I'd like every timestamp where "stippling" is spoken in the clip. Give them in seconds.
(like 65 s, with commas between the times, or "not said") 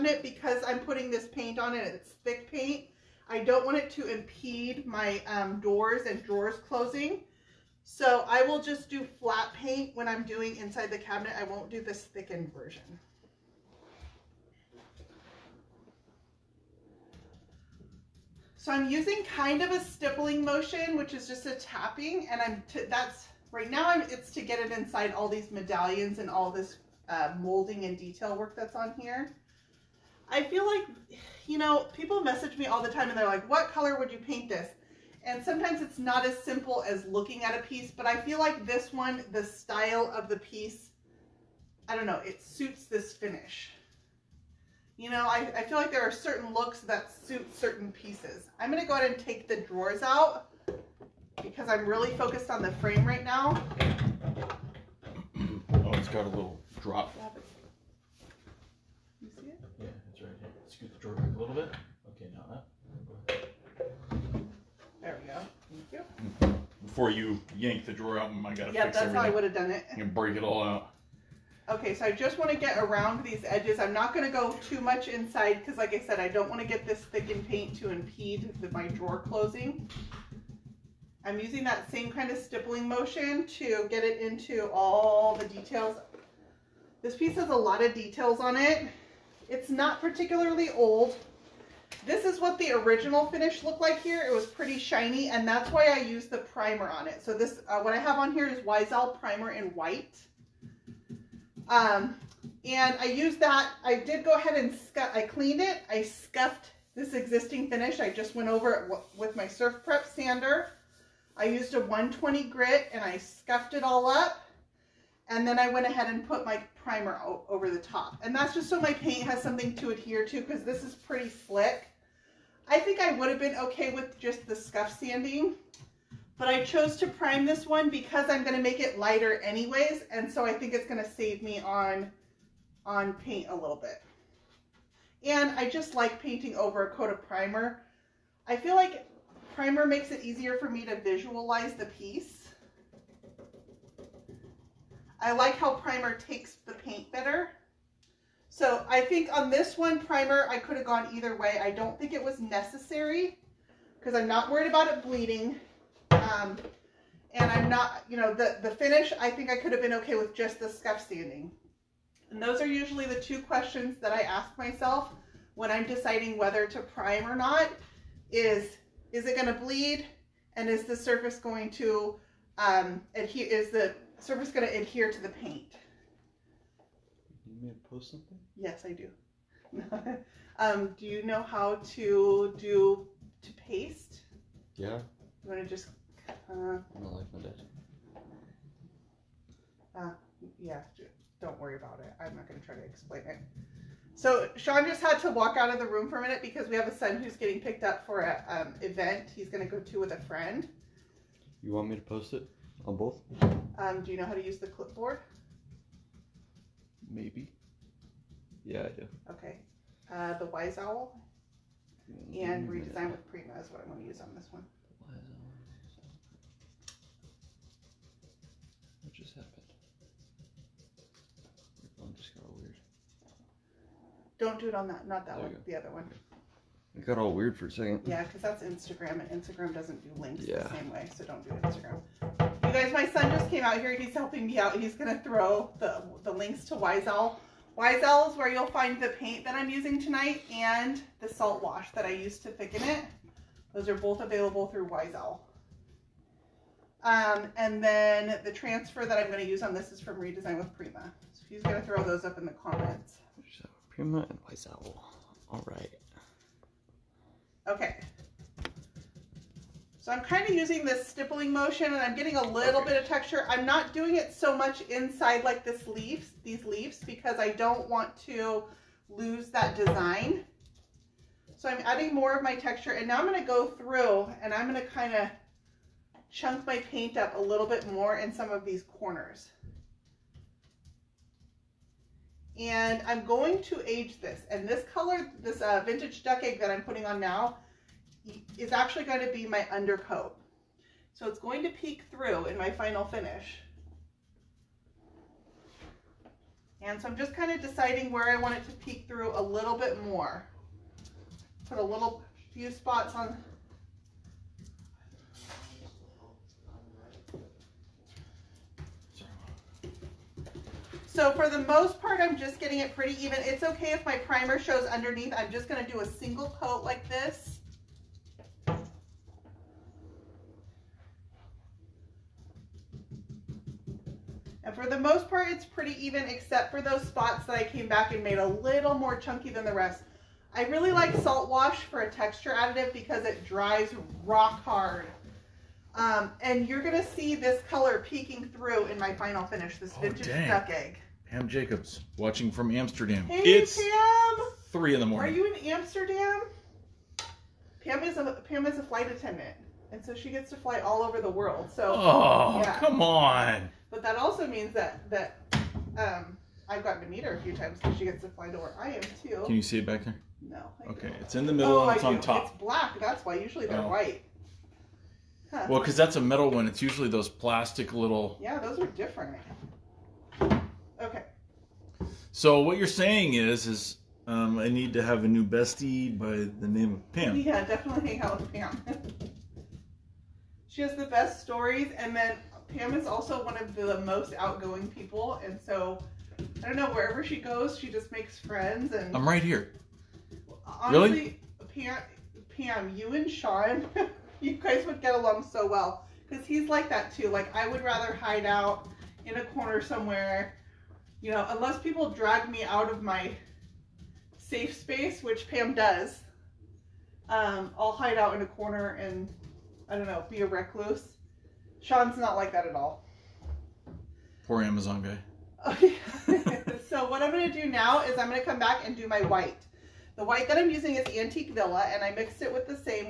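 19 s, 82 s, 261 s.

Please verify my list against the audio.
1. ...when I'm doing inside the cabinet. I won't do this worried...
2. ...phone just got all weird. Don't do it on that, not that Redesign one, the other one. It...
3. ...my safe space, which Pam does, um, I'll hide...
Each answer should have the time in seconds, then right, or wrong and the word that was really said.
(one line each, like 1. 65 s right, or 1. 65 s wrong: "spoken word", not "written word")
1. 9 s wrong: "thickened", not "worried"
2. 221 s wrong: "There", not "Redesign"
3. 403 s right.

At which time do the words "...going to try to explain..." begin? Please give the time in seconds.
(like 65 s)
192 s.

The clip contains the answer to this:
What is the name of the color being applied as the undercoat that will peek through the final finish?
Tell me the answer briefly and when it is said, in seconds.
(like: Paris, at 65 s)
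vintage duck egg, at 285 s.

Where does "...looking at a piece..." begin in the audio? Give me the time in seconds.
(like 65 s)
37 s.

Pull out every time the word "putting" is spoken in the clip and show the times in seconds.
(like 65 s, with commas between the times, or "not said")
0 s, 286 s.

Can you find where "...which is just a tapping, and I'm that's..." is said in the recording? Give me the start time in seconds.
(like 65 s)
20 s.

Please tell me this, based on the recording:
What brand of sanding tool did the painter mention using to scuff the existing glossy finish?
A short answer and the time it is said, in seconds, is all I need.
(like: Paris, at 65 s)
Surf Prep, at 109 s.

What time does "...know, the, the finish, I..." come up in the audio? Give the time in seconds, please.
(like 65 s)
158 s.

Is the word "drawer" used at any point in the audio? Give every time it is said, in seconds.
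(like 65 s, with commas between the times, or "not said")
6 s, 49 s, 60 s, 67 s, 78 s.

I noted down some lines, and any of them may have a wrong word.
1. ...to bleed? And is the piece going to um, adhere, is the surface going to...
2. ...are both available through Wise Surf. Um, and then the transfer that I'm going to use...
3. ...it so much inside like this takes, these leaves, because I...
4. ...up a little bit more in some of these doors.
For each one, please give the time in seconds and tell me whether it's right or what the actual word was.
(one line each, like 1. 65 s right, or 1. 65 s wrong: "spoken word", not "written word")
1. 169 s wrong: "surface", not "piece"
2. 243 s wrong: "Owl", not "Surf"
3. 264 s wrong: "leaves", not "takes"
4. 277 s wrong: "corners", not "doors".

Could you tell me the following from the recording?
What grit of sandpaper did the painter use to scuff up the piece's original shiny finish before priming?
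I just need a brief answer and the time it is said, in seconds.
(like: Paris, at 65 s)
120, at 111 s.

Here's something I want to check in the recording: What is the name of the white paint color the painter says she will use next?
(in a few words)
Antique Villa.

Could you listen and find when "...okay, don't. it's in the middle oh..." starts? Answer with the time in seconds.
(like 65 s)
360 s.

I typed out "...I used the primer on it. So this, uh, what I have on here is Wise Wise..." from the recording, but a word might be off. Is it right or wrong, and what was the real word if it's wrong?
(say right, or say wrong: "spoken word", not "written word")
wrong: "Owl", not "Wise".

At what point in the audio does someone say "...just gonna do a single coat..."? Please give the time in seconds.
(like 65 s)
315 s.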